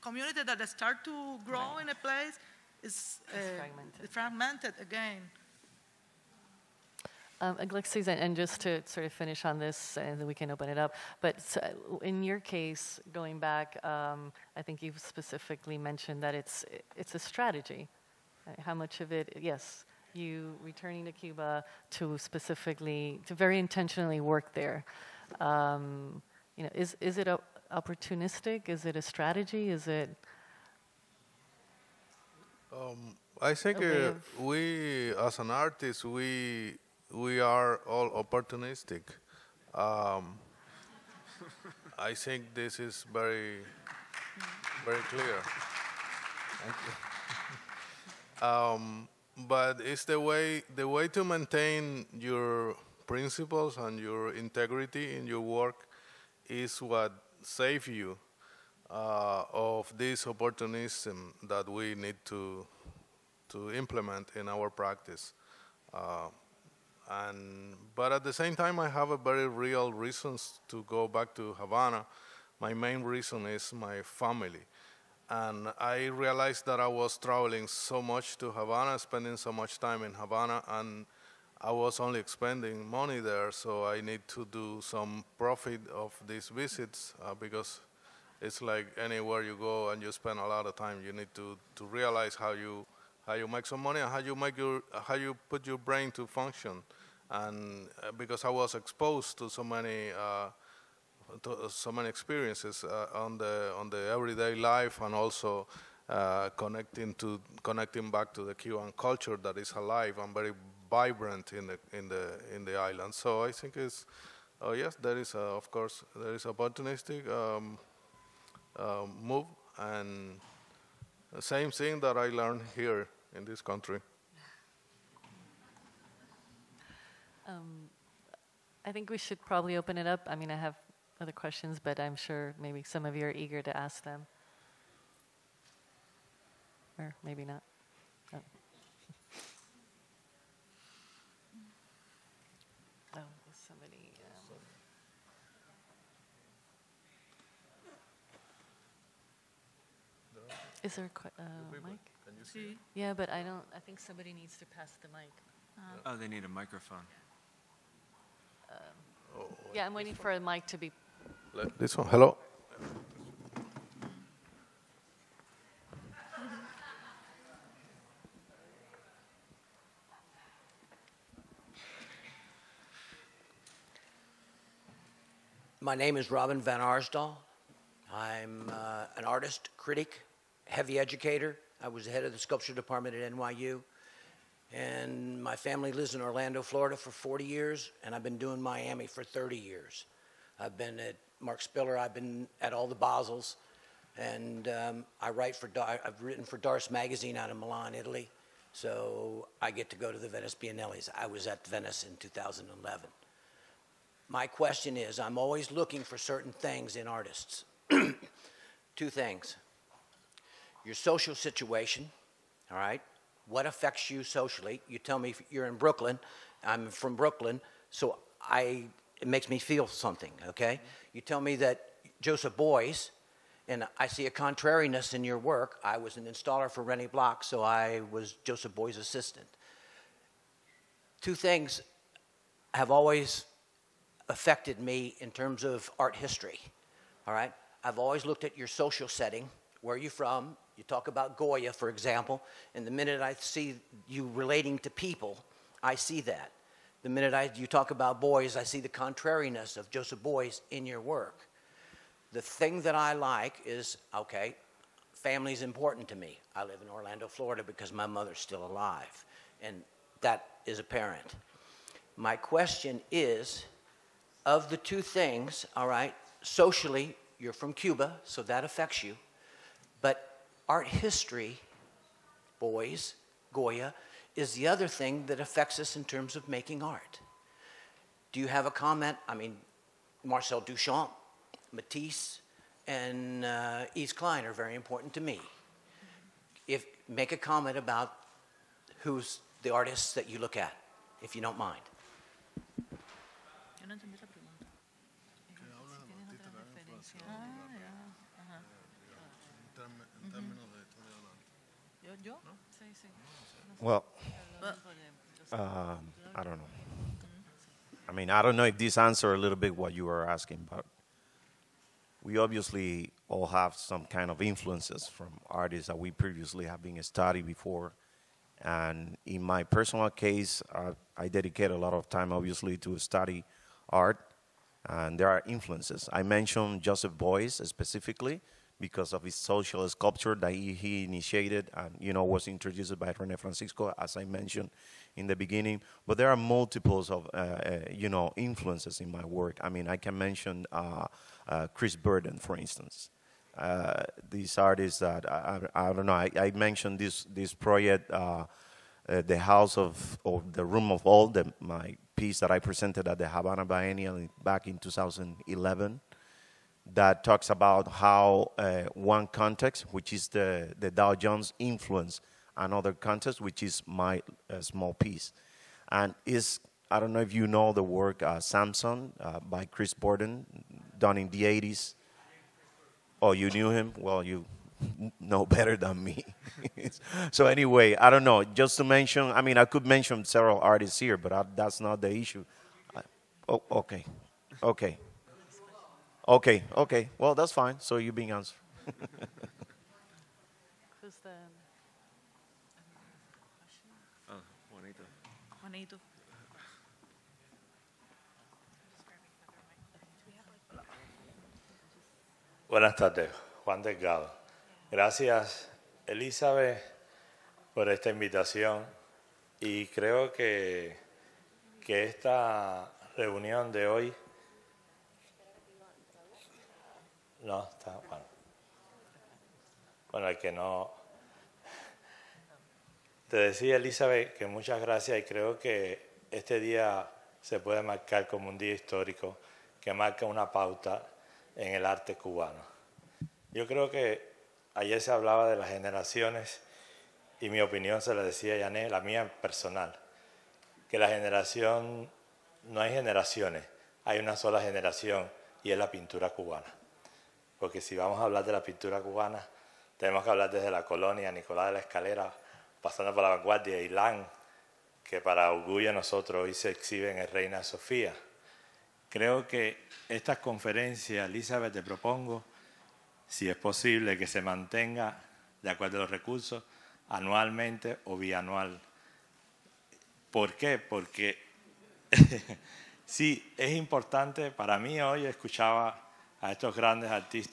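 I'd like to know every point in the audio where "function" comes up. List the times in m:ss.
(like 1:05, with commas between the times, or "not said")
1:36.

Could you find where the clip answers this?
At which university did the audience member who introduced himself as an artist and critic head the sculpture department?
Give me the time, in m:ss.
3:03.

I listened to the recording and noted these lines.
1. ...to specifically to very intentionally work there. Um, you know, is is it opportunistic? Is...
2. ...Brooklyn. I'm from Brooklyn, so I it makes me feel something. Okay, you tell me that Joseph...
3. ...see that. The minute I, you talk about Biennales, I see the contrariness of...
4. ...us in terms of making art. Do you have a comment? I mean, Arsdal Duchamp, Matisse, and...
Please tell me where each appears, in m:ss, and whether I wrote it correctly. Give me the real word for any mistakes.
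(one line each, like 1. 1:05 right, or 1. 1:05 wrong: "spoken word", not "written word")
1. 0:21 right
2. 3:35 right
3. 4:05 wrong: "Beuys", not "Biennales"
4. 4:35 wrong: "Marcel", not "Arsdal".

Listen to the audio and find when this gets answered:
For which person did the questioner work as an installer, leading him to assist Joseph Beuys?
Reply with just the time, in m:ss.
3:46.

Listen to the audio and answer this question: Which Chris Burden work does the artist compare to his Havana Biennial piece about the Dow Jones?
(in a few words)
Samson.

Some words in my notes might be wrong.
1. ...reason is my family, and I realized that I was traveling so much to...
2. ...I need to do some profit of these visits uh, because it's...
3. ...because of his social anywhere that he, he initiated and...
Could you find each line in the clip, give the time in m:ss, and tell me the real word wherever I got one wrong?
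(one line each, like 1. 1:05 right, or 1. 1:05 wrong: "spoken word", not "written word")
1. 1:13 right
2. 1:23 right
3. 5:28 wrong: "sculpture", not "anywhere".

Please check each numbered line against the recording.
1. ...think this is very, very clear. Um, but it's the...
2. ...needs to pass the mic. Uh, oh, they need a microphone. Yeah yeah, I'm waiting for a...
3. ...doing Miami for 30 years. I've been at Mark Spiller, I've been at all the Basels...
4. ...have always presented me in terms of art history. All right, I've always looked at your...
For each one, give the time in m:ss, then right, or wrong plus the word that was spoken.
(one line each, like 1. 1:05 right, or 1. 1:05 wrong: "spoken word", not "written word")
1. 0:42 right
2. 2:34 right
3. 3:08 right
4. 3:52 wrong: "affected", not "presented".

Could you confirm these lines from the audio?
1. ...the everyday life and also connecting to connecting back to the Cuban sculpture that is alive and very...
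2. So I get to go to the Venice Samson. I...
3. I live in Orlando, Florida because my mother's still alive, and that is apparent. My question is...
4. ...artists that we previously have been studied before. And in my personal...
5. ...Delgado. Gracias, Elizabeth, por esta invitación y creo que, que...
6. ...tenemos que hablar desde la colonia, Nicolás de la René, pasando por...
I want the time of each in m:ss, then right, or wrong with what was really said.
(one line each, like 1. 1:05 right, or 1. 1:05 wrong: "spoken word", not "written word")
1. 1:43 wrong: "culture", not "sculpture"
2. 3:18 wrong: "Biennales", not "Samson"
3. 4:16 right
4. 5:15 right
5. 6:43 right
6. 7:29 wrong: "Escalera", not "René".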